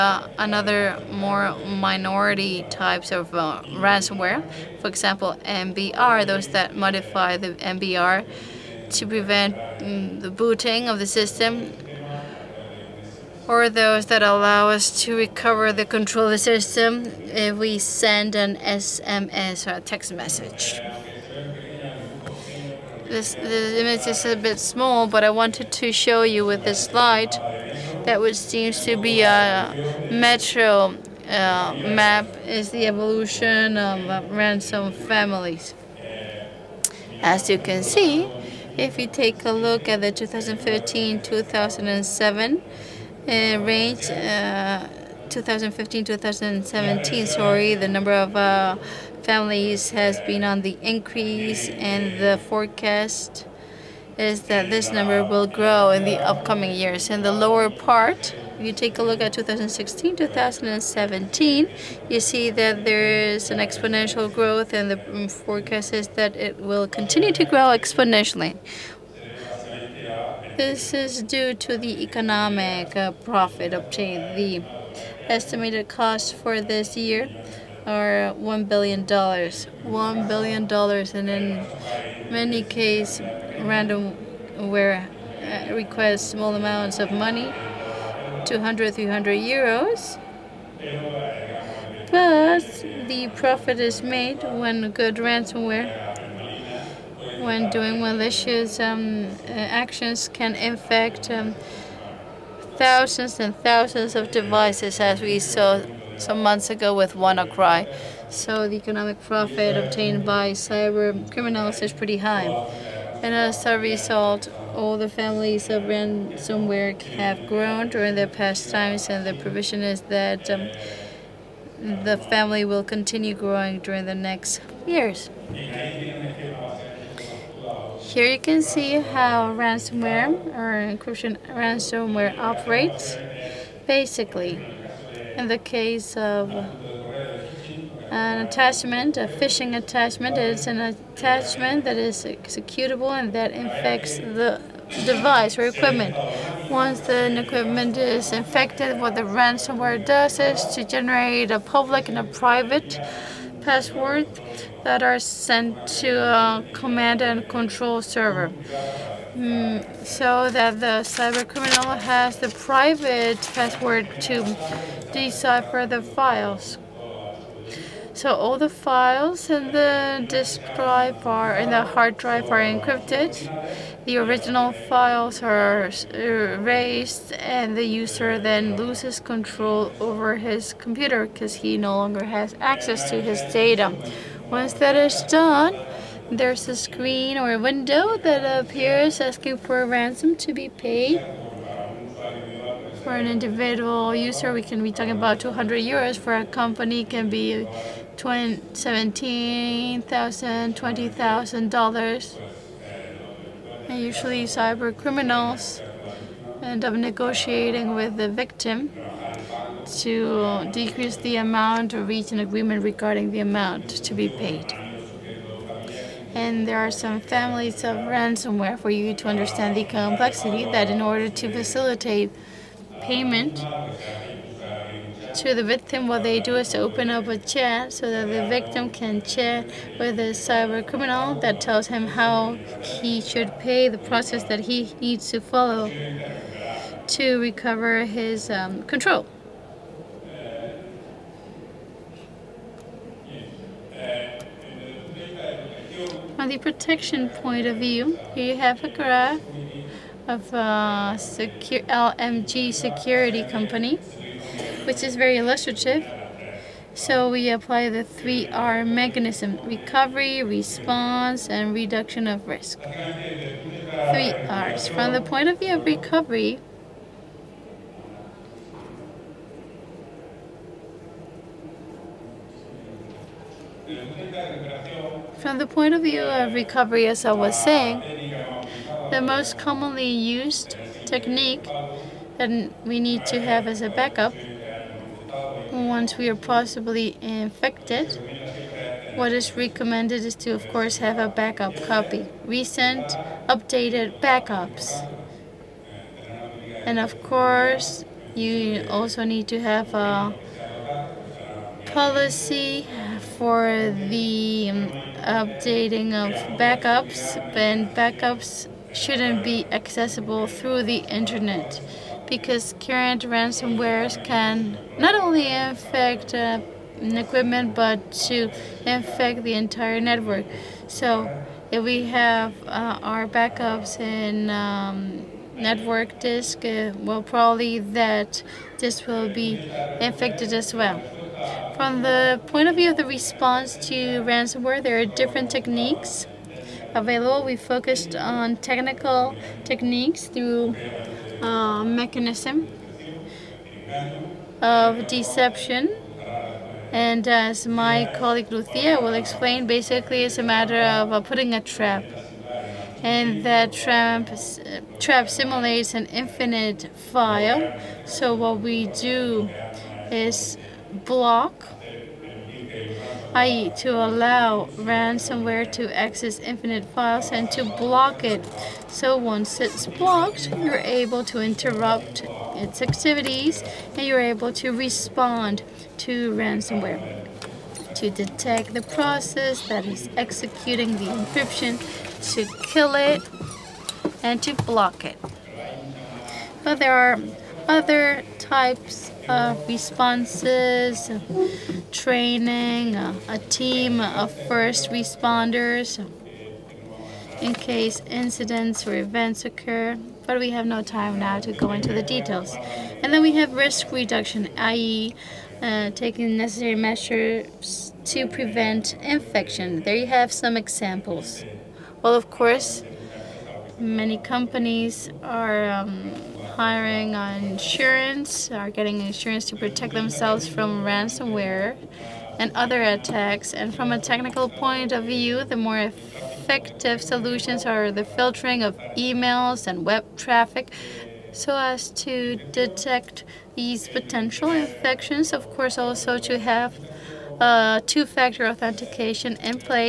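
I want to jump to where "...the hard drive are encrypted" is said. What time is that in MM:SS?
02:51.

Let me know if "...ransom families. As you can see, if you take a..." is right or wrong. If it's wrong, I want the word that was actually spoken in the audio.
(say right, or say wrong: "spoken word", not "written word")
right.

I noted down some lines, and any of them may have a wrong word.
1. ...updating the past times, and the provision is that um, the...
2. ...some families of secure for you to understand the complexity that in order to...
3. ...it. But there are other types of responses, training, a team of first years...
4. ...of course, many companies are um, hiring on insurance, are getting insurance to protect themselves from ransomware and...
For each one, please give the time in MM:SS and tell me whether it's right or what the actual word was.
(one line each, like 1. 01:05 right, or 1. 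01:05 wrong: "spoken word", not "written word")
1. 01:57 wrong: "during", not "updating"
2. 03:36 wrong: "ransomware", not "secure"
3. 06:25 wrong: "responders", not "years"
4. 06:52 right.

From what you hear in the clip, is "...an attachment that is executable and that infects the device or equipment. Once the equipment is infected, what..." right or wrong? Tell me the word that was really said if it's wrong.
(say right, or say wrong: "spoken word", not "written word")
right.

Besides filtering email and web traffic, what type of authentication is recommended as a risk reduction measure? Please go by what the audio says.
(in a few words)
two-factor authentication.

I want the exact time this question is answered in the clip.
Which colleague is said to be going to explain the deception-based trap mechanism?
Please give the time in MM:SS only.
05:48.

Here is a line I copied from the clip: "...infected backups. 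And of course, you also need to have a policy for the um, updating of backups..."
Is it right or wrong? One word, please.
wrong.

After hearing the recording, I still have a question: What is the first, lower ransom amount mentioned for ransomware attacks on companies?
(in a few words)
$17,000.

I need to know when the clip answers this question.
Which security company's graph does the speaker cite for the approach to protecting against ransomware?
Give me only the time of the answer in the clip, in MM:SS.
04:11.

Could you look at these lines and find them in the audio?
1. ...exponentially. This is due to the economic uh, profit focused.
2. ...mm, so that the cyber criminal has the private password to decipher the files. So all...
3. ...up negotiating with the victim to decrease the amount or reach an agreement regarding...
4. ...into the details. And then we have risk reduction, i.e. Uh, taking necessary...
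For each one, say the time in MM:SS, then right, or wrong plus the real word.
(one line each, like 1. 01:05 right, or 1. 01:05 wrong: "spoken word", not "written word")
1. 01:07 wrong: "obtained", not "focused"
2. 02:39 right
3. 03:26 right
4. 06:41 right.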